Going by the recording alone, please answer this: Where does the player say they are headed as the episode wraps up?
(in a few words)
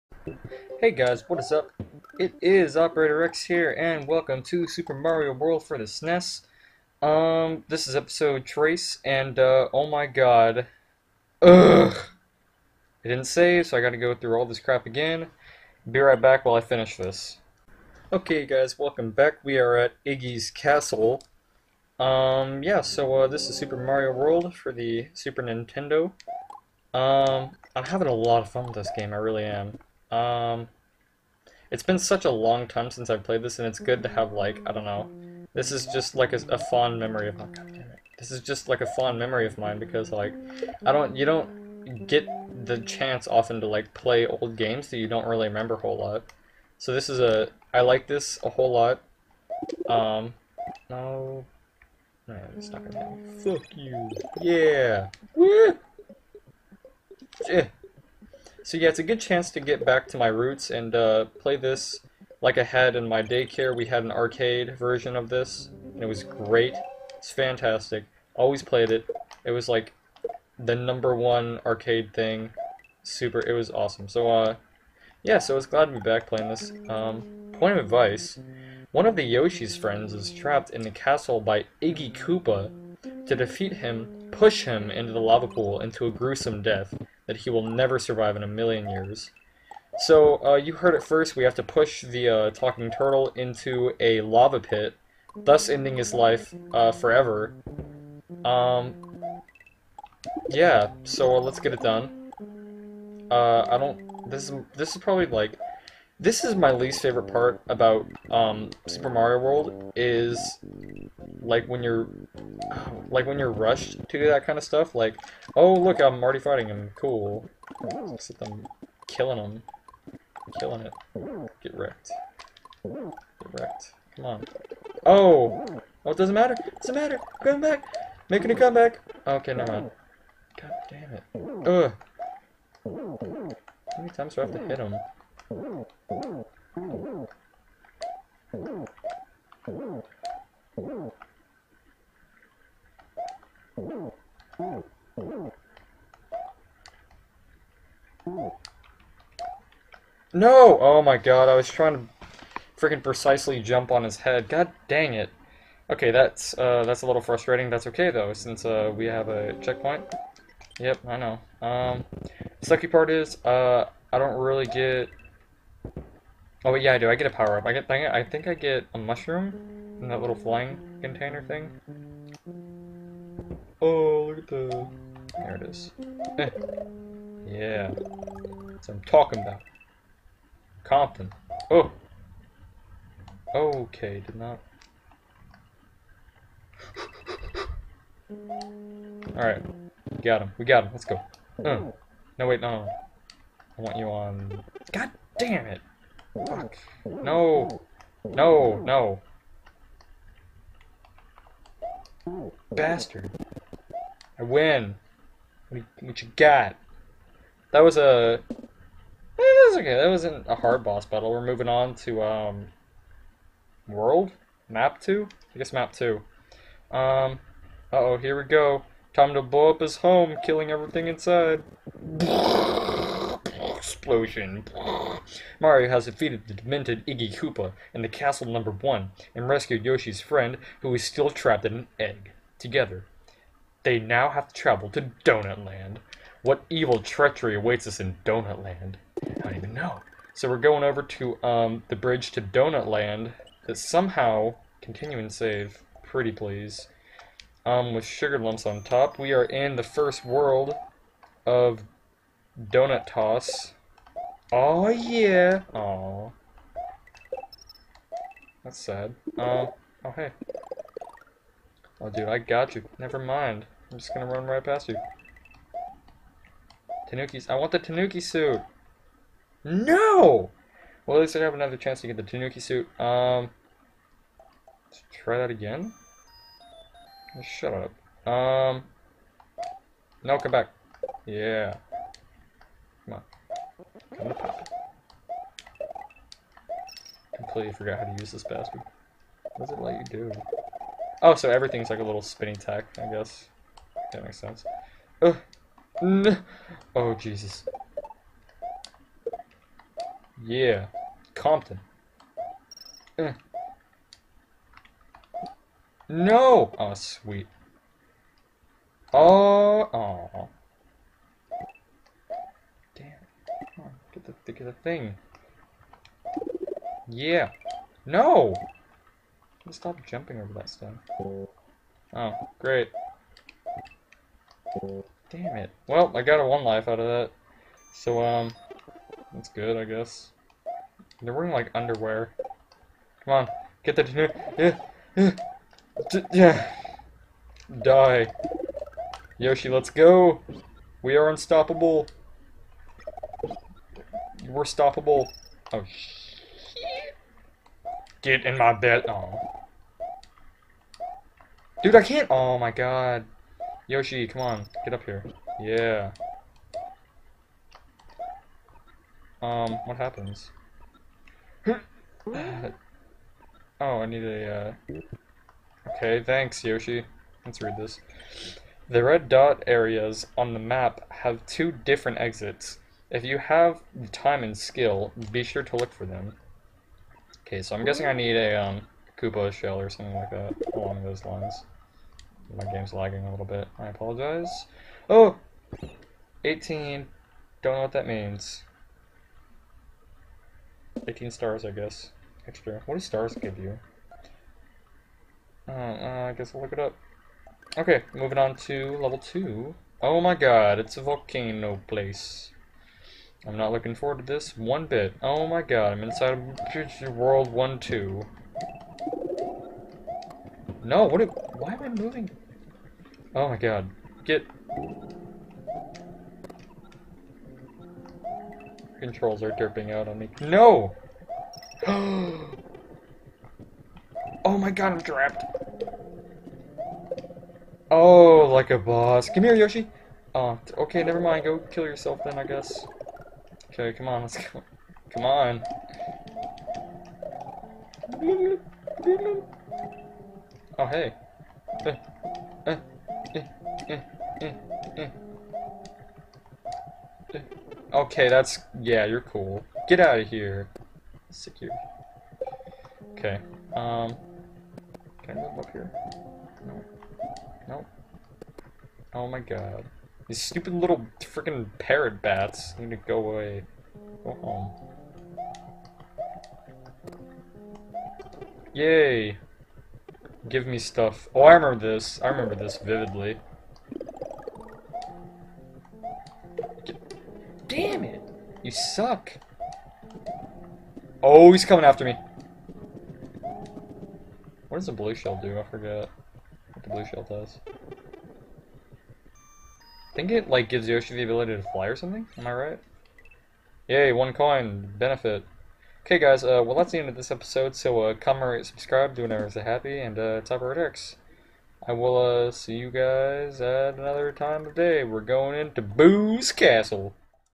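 Boo's Castle.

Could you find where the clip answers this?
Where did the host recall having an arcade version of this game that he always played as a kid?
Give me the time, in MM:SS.
01:03.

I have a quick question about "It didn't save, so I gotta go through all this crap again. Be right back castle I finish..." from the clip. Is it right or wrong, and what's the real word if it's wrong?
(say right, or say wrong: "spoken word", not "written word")
wrong: "while", not "castle".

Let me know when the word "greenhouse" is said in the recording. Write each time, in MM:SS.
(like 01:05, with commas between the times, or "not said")
not said.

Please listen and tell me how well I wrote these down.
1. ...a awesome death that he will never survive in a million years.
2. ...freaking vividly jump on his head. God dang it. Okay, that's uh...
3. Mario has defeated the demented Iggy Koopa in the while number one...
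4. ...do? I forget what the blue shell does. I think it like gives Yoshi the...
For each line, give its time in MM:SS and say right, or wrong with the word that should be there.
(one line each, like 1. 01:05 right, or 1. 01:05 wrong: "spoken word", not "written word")
1. 01:26 wrong: "gruesome", not "awesome"
2. 02:32 wrong: "precisely", not "vividly"
3. 03:45 wrong: "castle", not "while"
4. 08:05 right.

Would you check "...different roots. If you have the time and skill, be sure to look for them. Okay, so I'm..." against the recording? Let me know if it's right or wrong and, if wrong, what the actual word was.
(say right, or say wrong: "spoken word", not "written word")
wrong: "exits", not "roots".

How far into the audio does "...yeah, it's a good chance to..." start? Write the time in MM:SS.
00:58.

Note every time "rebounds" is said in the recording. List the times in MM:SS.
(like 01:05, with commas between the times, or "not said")
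not said.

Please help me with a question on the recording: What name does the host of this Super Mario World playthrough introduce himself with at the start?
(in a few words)
Operator X.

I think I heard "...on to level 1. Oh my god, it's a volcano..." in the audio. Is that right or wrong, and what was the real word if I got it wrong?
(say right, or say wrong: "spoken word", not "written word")
wrong: "2", not "1".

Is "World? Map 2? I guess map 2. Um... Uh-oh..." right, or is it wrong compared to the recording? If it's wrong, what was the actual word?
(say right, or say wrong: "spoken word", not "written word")
right.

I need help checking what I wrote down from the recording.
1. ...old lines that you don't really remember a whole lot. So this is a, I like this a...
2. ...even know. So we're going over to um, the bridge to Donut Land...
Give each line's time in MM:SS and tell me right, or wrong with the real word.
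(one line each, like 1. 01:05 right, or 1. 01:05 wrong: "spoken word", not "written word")
1. 00:44 wrong: "games", not "lines"
2. 03:59 right.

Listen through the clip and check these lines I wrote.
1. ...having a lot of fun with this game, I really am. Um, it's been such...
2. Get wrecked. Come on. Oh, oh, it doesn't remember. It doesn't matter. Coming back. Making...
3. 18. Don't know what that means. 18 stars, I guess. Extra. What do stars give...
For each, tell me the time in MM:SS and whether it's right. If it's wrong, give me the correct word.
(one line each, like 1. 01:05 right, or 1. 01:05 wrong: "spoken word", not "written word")
1. 00:27 right
2. 02:02 wrong: "matter", not "remember"
3. 06:26 right.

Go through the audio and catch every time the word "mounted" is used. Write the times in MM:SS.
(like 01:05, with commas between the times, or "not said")
not said.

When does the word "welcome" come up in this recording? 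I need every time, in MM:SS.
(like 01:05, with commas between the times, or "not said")
00:04, 00:18.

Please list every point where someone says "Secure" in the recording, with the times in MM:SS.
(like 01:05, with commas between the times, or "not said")
07:31.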